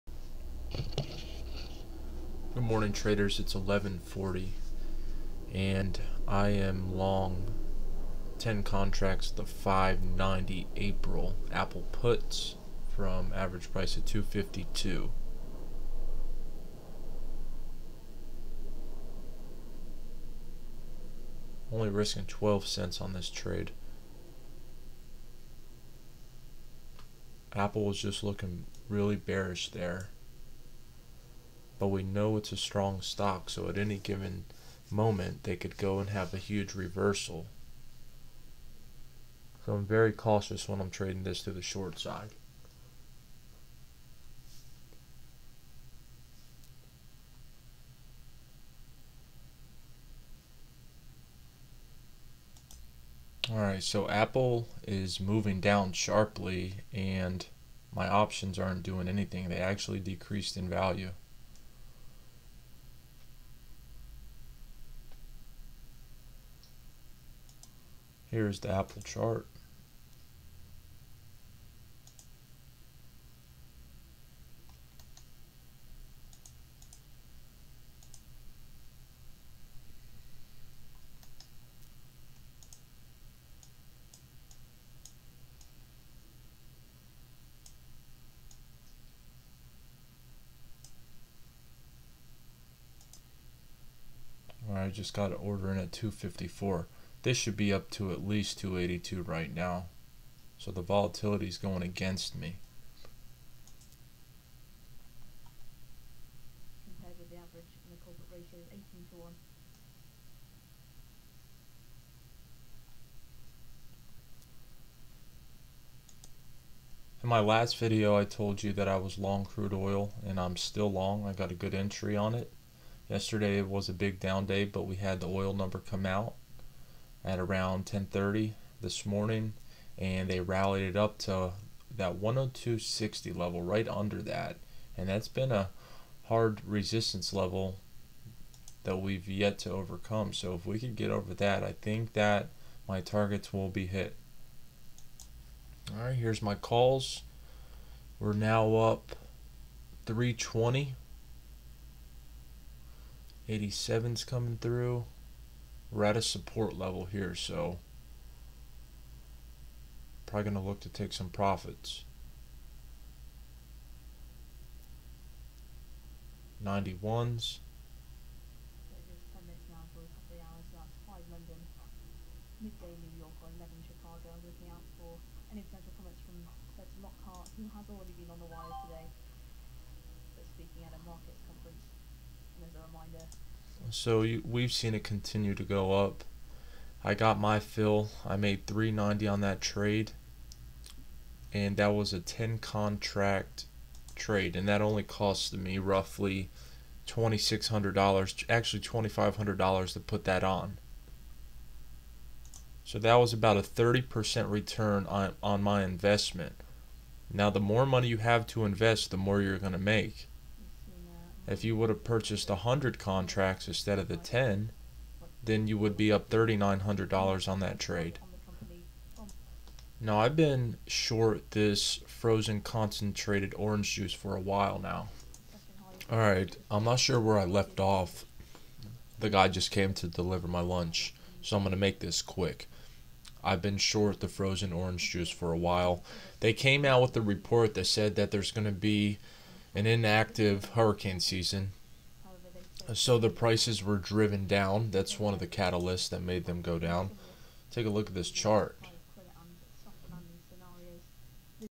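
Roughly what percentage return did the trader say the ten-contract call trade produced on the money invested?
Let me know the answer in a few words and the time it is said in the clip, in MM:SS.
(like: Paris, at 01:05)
30%, at 03:23.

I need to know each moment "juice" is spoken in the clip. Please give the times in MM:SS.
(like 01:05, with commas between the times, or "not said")
03:43, 03:55.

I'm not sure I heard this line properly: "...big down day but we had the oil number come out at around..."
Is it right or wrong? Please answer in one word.
right.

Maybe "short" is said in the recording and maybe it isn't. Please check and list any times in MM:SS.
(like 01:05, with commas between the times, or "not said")
00:41, 03:40, 03:53.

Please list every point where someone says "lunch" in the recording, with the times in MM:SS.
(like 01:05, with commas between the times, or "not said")
03:50.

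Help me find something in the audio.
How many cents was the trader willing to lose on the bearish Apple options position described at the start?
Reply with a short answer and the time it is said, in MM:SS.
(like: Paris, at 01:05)
12 cents, at 00:22.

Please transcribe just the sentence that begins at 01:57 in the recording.
In my last video I told you that I was long crude oil and I'm still long.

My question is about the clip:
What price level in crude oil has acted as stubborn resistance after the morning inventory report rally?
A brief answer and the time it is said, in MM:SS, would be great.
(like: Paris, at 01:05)
102.60, at 02:12.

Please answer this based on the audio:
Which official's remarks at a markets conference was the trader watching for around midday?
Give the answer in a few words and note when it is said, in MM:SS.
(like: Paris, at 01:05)
Lockhart, at 02:57.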